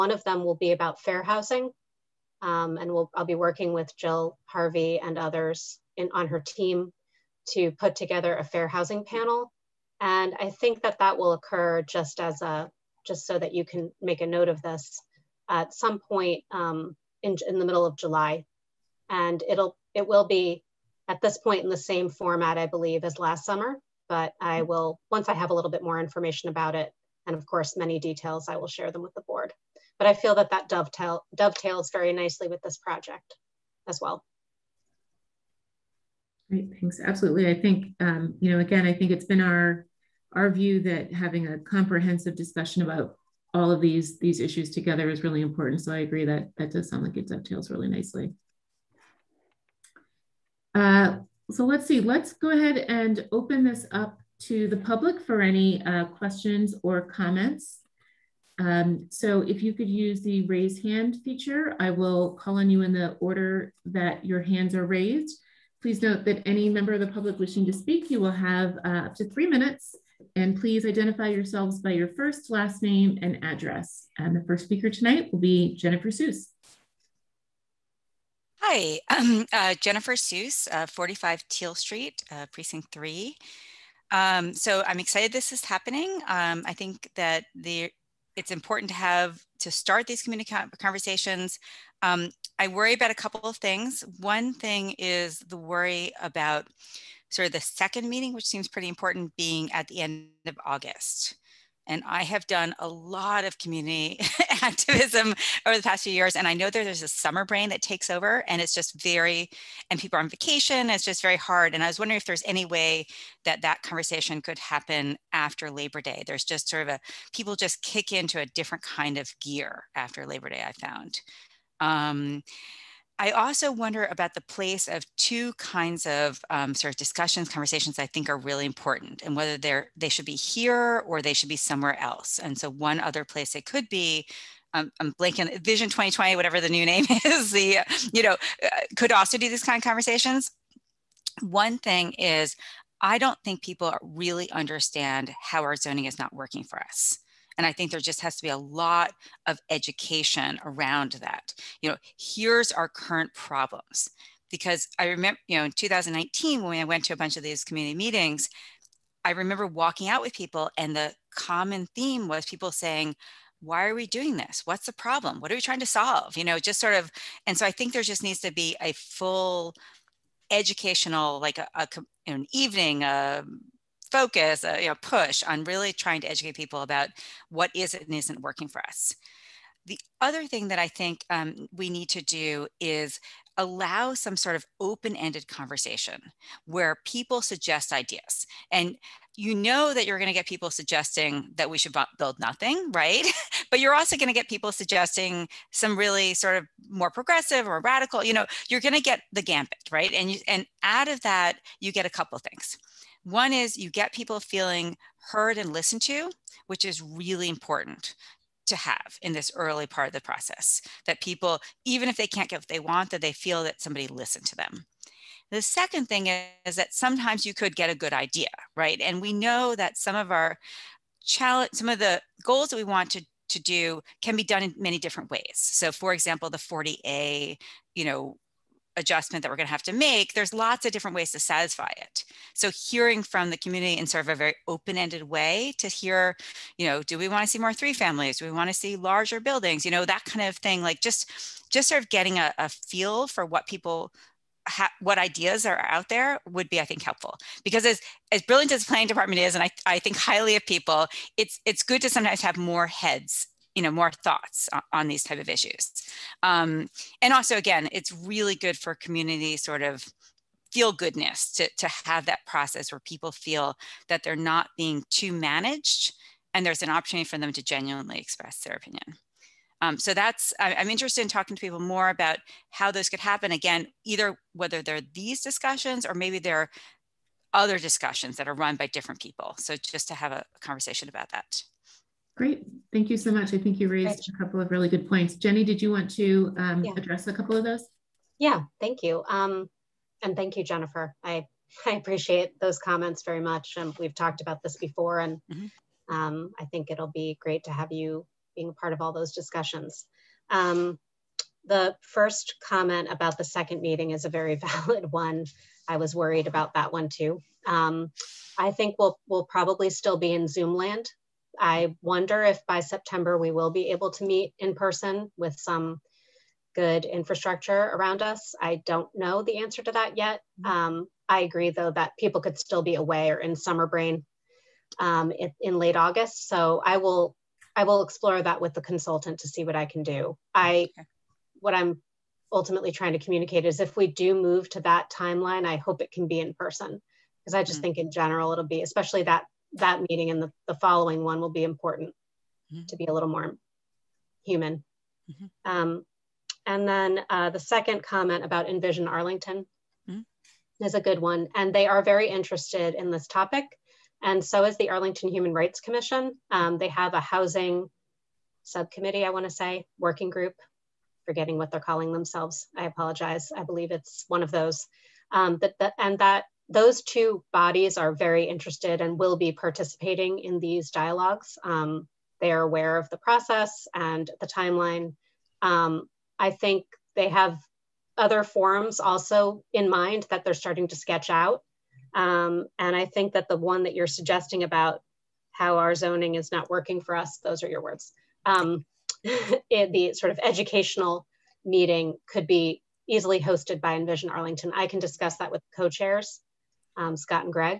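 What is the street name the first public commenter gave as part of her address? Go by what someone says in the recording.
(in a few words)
Teel Street.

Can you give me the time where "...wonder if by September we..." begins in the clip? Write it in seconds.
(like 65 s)
311 s.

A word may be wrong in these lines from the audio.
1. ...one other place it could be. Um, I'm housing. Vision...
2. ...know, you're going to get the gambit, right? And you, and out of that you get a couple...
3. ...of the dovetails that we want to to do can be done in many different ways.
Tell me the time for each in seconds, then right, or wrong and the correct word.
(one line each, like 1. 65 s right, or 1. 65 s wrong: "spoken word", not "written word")
1. 132 s wrong: "blanking", not "housing"
2. 198 s right
3. 221 s wrong: "goals", not "dovetails".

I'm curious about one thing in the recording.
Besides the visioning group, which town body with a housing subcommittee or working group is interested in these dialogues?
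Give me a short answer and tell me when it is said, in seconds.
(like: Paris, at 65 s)
Arlington Human Rights Commission, at 354 s.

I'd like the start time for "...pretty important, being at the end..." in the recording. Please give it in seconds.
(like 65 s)
98 s.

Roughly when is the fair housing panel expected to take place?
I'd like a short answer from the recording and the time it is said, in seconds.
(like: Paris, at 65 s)
Middle of July, at 17 s.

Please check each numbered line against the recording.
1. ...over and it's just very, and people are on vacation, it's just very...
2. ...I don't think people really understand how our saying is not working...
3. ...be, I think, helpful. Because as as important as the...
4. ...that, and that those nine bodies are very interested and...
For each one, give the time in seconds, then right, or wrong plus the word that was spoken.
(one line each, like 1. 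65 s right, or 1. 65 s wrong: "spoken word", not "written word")
1. 108 s right
2. 143 s wrong: "zoning", not "saying"
3. 246 s wrong: "brilliant", not "important"
4. 365 s wrong: "two", not "nine".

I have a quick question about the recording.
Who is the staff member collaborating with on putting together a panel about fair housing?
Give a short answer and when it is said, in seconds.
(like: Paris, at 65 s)
Jill Harvey, at 3 s.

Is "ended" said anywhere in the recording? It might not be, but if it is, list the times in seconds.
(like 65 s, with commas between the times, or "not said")
185 s, 234 s.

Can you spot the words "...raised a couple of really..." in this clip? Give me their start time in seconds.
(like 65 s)
283 s.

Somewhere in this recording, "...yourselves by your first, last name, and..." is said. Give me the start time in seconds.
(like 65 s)
71 s.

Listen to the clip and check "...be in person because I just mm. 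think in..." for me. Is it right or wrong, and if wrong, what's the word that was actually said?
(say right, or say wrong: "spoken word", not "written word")
right.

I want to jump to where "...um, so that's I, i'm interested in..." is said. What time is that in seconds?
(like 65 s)
269 s.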